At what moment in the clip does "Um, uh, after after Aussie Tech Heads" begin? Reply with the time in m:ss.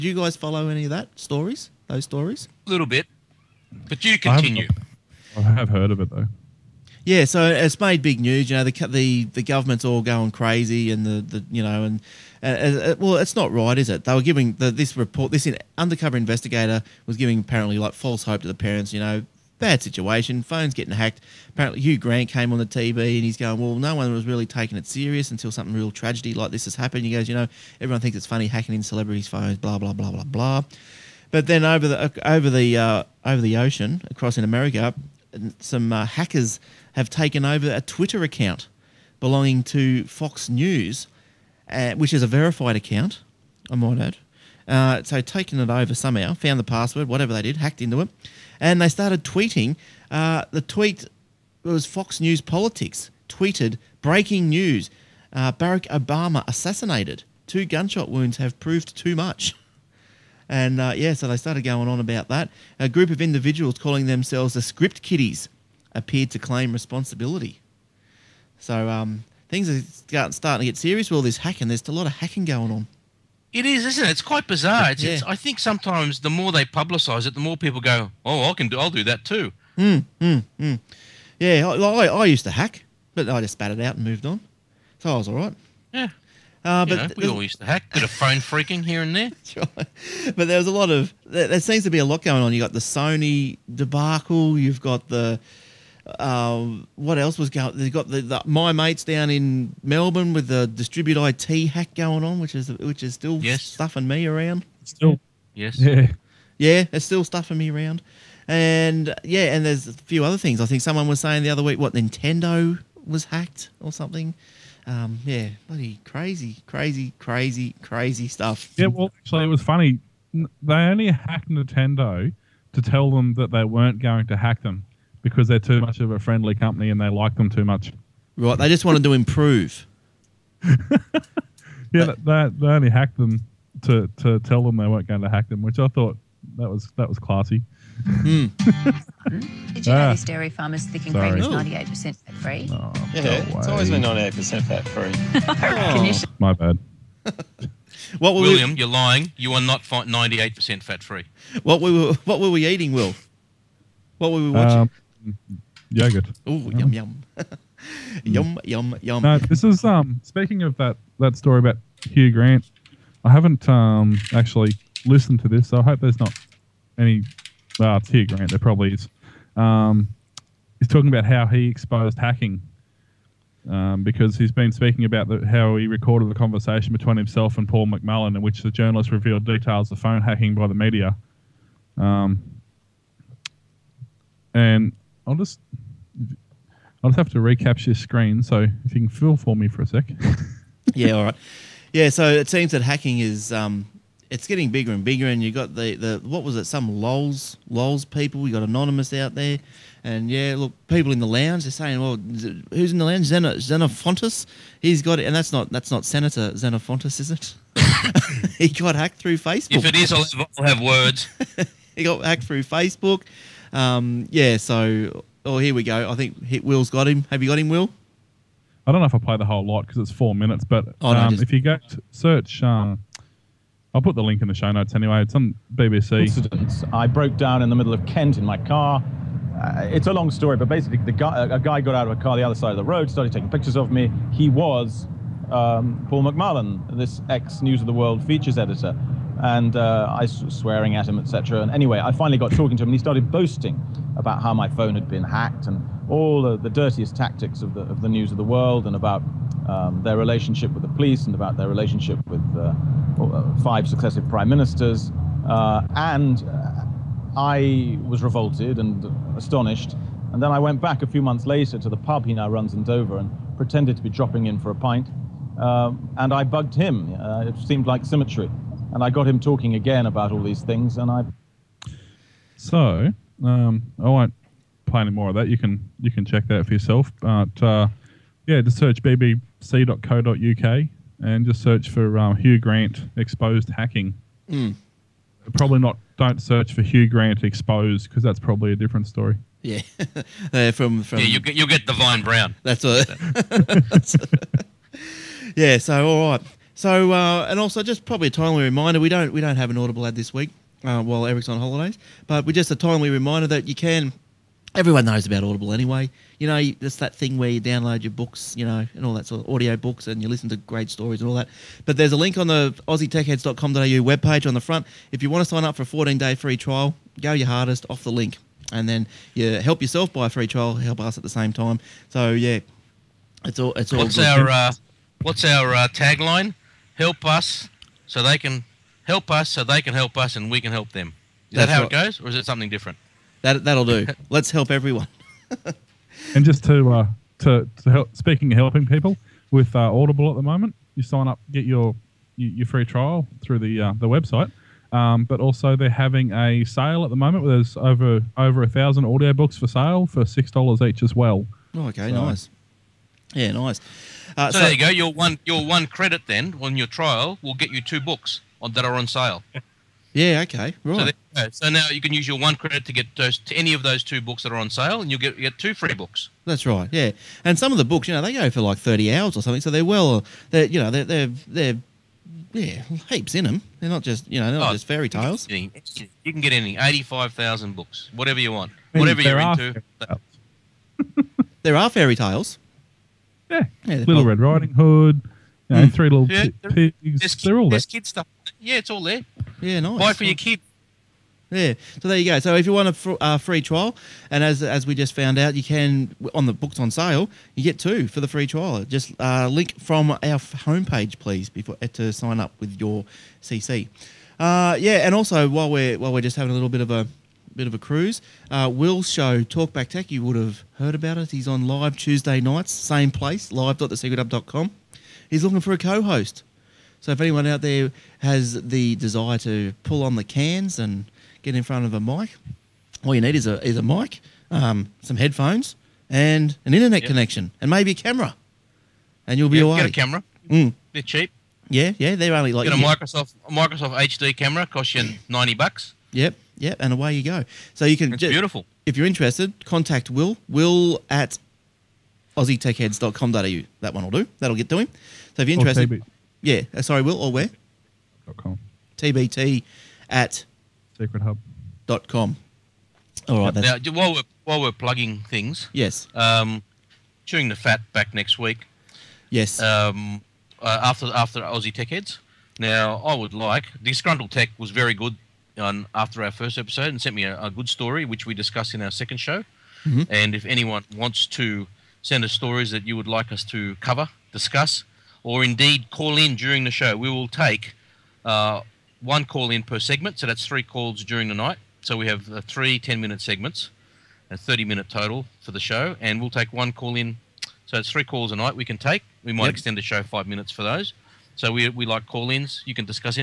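7:39.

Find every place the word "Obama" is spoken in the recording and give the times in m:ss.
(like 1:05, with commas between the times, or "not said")
0:55.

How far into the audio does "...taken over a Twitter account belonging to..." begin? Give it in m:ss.
0:37.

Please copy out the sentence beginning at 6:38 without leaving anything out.
Just uh, link from our homepage, please, before uh, to sign up with your CC.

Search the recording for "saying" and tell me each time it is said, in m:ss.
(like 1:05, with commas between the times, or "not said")
1:51, 3:21.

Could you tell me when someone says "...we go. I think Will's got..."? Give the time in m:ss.
3:35.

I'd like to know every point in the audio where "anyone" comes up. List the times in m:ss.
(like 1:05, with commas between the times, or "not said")
6:57, 7:50.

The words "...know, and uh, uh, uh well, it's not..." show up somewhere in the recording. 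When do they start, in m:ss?
0:11.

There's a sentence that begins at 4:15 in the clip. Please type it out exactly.
Uh, and uh, I was revolted and astonished.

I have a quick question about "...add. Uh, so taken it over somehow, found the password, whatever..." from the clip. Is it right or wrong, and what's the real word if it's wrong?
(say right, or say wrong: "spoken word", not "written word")
right.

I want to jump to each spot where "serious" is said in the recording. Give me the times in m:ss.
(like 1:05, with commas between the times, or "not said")
0:24, 1:10.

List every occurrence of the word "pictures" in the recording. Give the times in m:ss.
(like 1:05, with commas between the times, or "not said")
3:53.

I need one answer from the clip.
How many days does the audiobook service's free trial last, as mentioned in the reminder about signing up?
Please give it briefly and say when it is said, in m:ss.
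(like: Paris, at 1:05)
14, at 5:15.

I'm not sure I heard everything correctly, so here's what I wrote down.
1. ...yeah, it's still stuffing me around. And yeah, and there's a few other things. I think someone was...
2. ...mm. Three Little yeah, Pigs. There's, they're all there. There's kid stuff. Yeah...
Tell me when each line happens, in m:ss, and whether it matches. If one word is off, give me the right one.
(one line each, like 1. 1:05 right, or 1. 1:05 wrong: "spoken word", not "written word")
1. 1:46 right
2. 6:25 right.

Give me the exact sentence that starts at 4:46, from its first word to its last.
Don't search for Hugh Grant exposed because that's probably a different story.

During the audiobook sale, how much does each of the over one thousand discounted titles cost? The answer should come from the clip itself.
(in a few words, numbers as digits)
6 dollars.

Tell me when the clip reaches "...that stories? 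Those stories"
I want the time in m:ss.
0:00.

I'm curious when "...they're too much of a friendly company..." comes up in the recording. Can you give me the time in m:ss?
2:05.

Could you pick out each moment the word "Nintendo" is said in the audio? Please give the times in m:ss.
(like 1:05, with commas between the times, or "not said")
1:51, 2:01.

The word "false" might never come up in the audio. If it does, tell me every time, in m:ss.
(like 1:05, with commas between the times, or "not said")
0:17.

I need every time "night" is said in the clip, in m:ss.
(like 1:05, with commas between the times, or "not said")
6:52, 8:01, 8:08.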